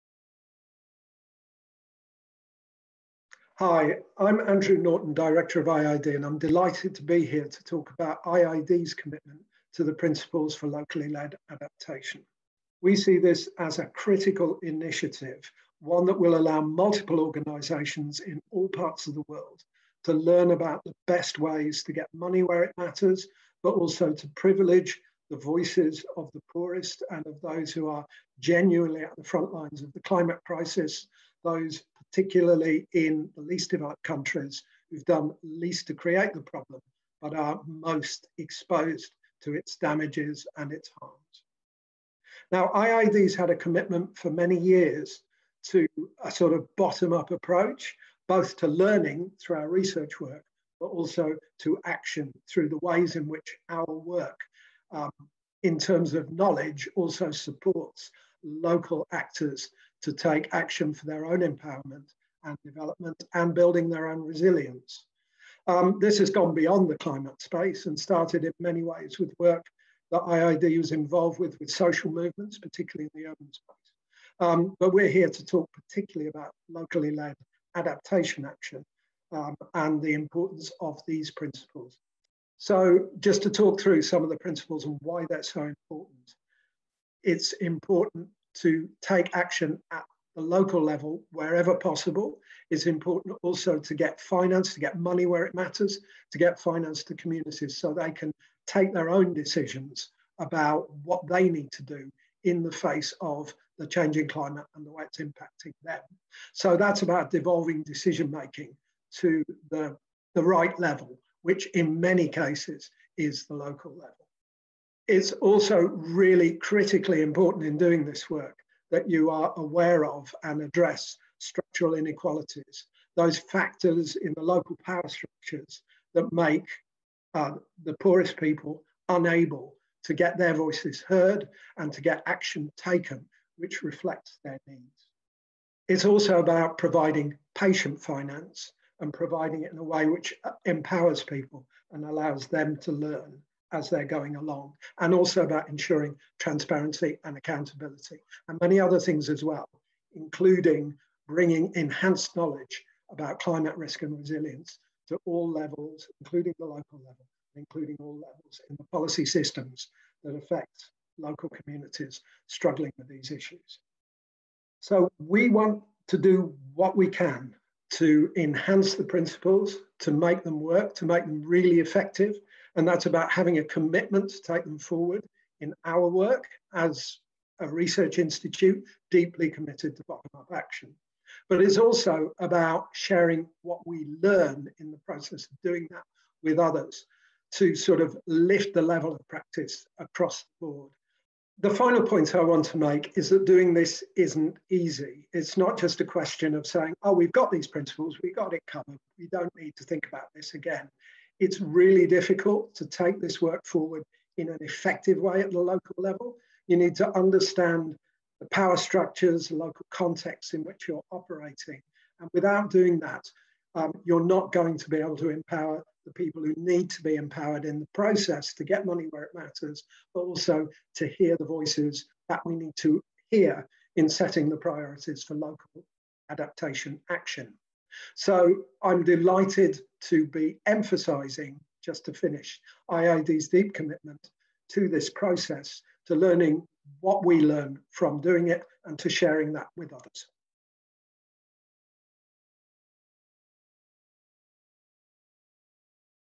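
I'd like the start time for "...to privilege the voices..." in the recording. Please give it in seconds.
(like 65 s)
24 s.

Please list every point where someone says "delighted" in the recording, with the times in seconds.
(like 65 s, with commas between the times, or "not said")
6 s, 229 s.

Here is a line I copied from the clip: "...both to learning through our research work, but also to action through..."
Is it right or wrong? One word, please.
right.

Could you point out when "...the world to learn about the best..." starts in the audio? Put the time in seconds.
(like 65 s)
19 s.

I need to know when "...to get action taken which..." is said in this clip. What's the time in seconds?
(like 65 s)
131 s.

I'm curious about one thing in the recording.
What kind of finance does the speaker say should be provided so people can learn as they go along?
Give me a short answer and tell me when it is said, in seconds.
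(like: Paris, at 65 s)
Patient finance, at 137 s.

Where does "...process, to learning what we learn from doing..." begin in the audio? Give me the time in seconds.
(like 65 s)
235 s.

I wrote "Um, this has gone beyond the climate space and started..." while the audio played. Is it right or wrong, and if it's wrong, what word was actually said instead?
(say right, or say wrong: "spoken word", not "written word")
right.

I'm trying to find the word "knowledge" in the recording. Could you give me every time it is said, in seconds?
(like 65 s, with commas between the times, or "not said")
56 s, 152 s.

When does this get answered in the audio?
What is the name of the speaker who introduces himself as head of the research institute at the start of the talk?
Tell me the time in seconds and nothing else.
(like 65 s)
4 s.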